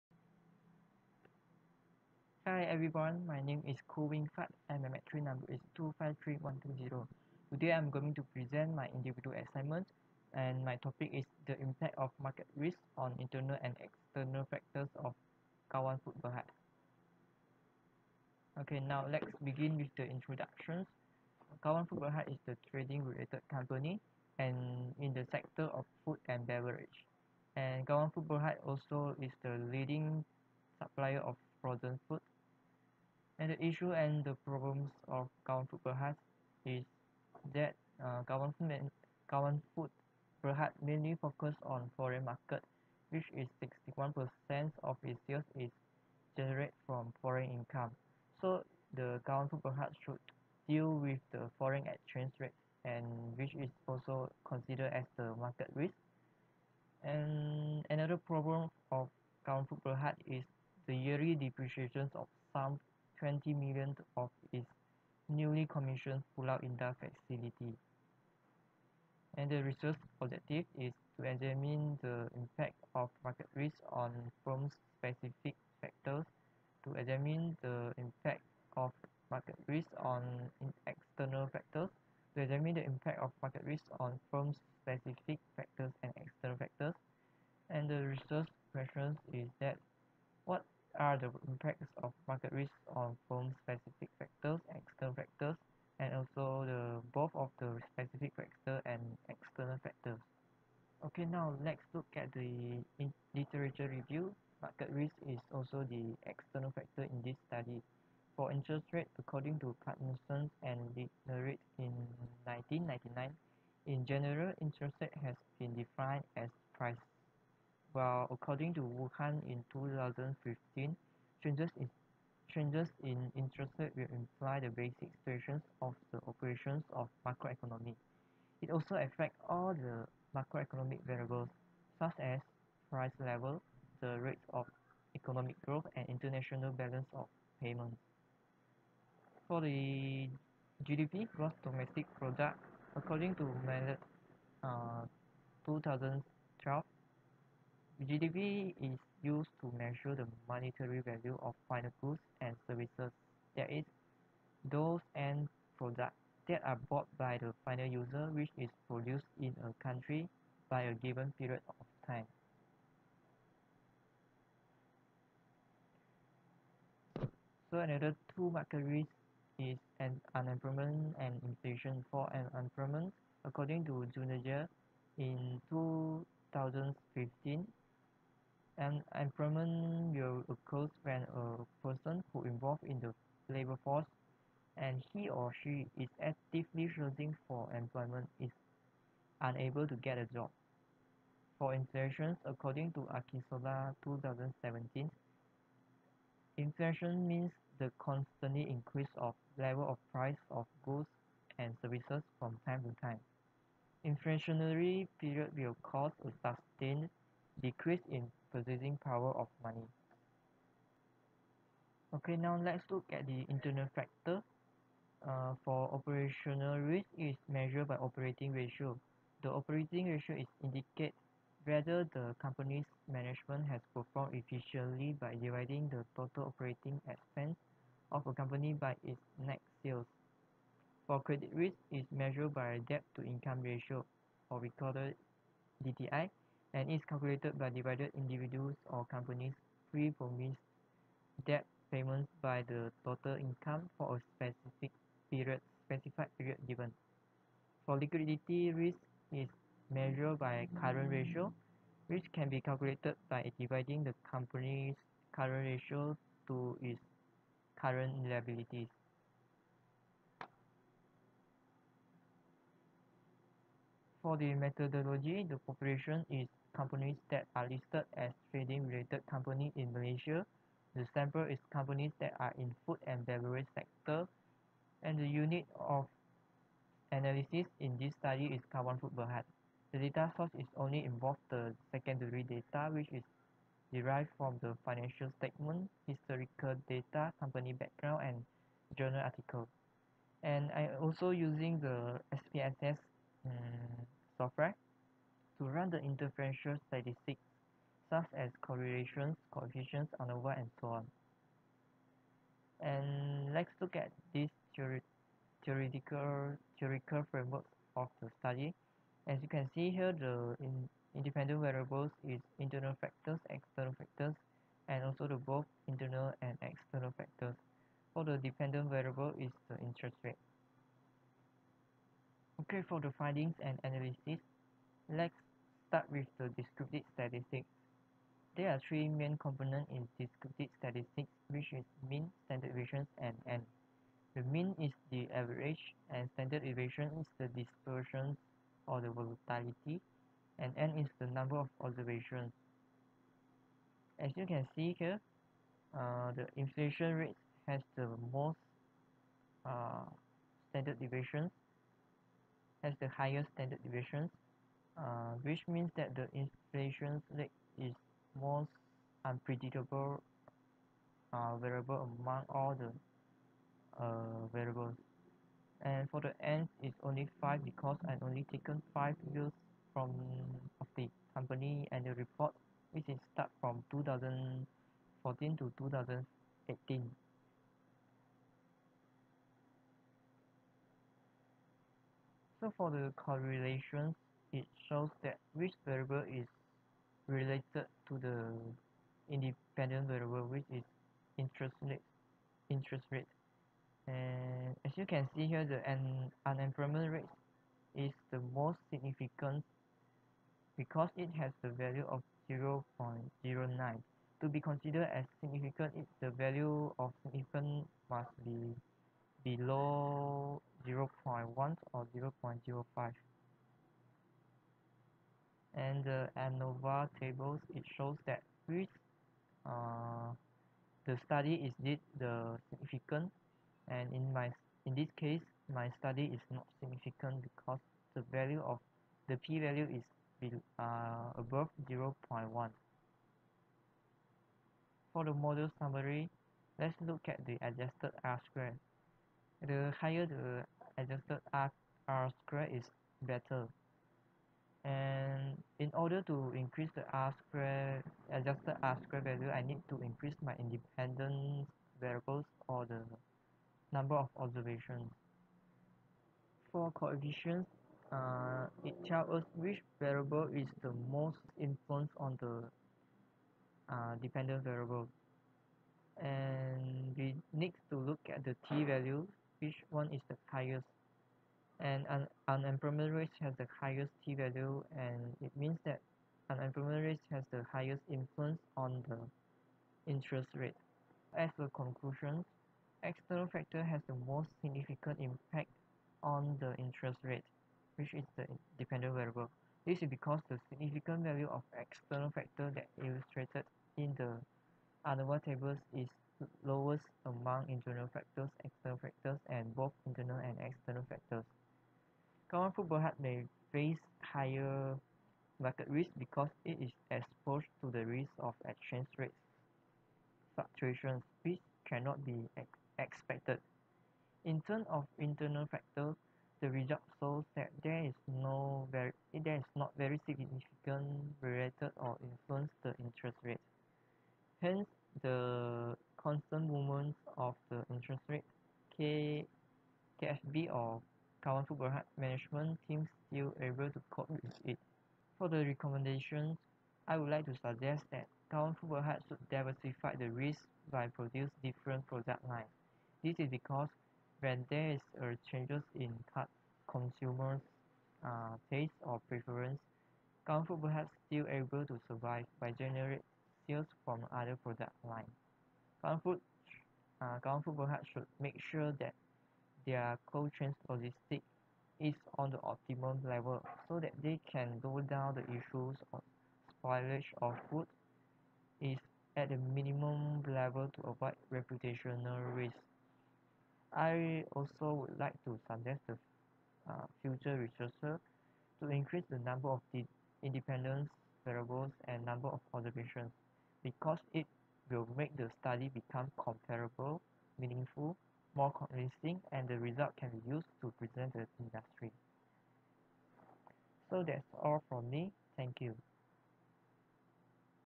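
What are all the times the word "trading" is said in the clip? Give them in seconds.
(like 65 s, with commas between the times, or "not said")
22 s, 268 s.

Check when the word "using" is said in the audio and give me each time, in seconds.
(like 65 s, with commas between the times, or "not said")
291 s.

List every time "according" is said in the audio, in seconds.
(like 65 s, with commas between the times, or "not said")
109 s, 118 s, 142 s, 173 s, 192 s.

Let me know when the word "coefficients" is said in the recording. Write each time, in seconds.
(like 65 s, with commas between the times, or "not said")
299 s, 456 s.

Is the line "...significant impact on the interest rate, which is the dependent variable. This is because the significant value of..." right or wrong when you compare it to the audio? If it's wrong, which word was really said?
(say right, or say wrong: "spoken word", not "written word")
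right.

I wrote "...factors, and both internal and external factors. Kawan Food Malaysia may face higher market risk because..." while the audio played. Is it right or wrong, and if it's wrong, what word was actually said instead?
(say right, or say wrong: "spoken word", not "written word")
wrong: "Berhad", not "Malaysia".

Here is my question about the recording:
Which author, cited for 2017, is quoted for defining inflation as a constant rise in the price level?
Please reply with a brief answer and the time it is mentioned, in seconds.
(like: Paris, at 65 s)
Akisola, at 193 s.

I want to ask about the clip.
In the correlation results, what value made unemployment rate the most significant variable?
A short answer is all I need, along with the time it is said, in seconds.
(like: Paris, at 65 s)
0.09, at 402 s.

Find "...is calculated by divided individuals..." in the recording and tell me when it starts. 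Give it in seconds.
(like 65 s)
236 s.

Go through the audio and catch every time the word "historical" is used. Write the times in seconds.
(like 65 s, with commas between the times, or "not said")
286 s.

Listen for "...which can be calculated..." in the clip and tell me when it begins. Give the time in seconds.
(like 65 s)
252 s.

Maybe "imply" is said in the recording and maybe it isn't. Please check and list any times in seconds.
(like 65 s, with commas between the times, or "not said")
124 s.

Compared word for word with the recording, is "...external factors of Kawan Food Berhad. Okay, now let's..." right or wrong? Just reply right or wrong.
right.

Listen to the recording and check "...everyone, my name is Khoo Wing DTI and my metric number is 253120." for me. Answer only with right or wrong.
wrong.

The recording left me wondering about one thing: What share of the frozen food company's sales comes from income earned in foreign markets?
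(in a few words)
61%.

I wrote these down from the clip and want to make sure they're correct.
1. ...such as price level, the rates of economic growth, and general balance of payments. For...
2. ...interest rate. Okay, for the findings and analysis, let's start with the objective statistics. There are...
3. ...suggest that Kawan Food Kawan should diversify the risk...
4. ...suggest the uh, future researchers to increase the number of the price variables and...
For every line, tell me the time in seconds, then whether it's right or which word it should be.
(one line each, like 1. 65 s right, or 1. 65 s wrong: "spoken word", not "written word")
1. 131 s wrong: "international", not "general"
2. 319 s wrong: "descriptive", not "objective"
3. 537 s wrong: "Berhad", not "Kawan"
4. 575 s wrong: "independence", not "price".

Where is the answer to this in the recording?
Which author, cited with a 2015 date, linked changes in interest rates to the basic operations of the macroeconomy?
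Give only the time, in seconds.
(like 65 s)
118 s.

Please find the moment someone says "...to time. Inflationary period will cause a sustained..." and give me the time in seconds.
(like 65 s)
202 s.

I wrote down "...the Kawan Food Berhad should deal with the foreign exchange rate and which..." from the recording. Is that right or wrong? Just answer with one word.
right.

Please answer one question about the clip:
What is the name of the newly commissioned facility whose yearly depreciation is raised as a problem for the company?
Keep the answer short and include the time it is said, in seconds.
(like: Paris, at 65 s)
Pulau Indah, at 66 s.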